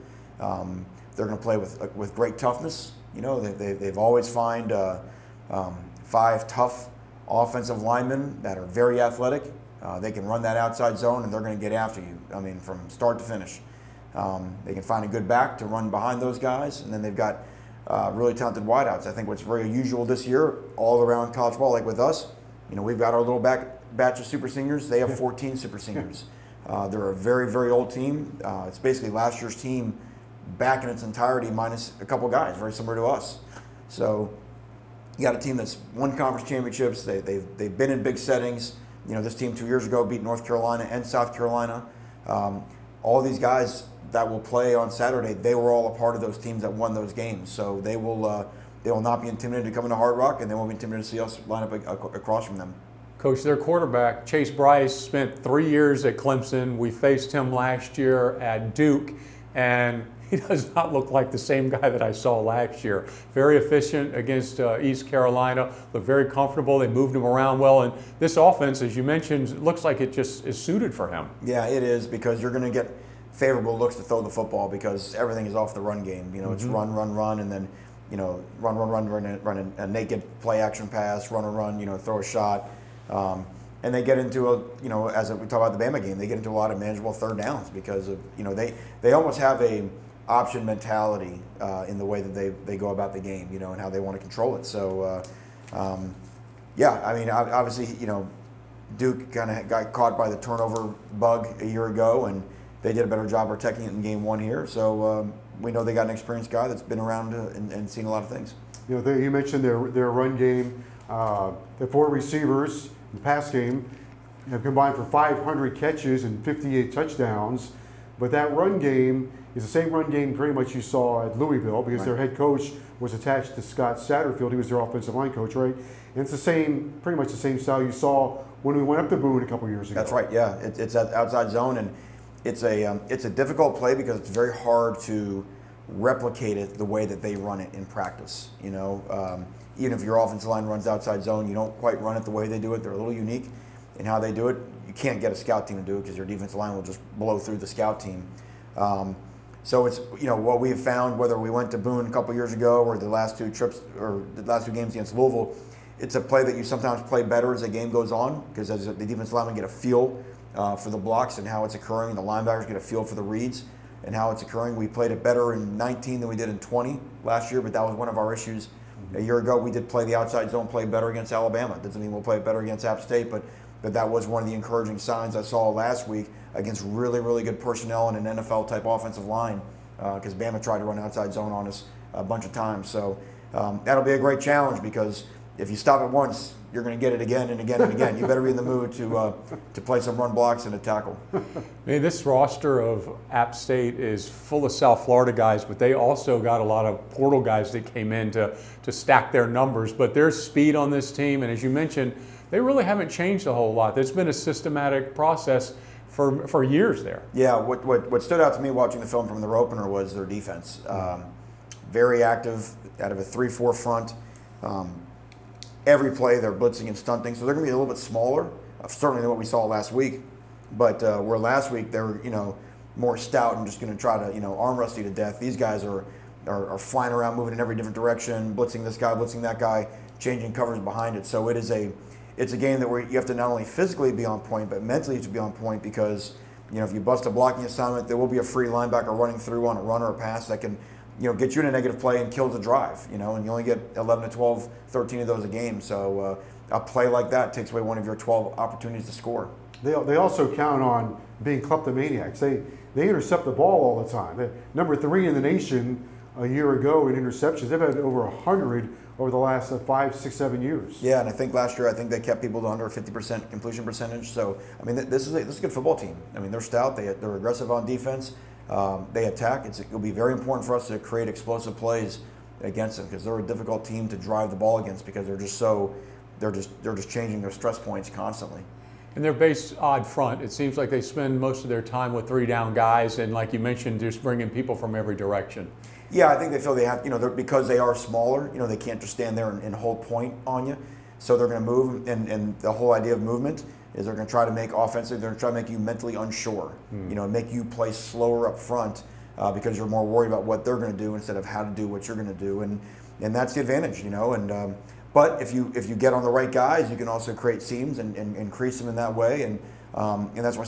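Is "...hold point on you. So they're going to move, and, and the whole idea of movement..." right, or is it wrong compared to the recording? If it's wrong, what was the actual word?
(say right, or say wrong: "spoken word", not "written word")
right.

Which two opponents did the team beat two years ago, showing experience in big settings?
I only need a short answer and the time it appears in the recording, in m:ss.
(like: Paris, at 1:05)
North Carolina and South Carolina, at 0:40.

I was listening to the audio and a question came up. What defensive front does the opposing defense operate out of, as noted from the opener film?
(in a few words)
3-4.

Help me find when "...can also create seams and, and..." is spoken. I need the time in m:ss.
5:06.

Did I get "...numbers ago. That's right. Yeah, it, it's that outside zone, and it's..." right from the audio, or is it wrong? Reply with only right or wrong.
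wrong.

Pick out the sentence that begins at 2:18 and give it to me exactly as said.
You know, um, even if your offensive line runs outside zone, you don't quite run it the way they do it.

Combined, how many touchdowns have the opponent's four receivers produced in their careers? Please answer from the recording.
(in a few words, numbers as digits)
58.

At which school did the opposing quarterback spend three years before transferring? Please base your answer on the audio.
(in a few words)
Clemson.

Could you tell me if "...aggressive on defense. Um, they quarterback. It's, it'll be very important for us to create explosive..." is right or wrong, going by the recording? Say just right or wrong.
wrong.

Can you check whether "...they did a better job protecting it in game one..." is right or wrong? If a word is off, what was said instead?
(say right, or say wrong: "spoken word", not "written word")
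right.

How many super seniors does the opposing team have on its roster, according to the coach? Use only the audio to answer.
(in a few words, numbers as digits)
14.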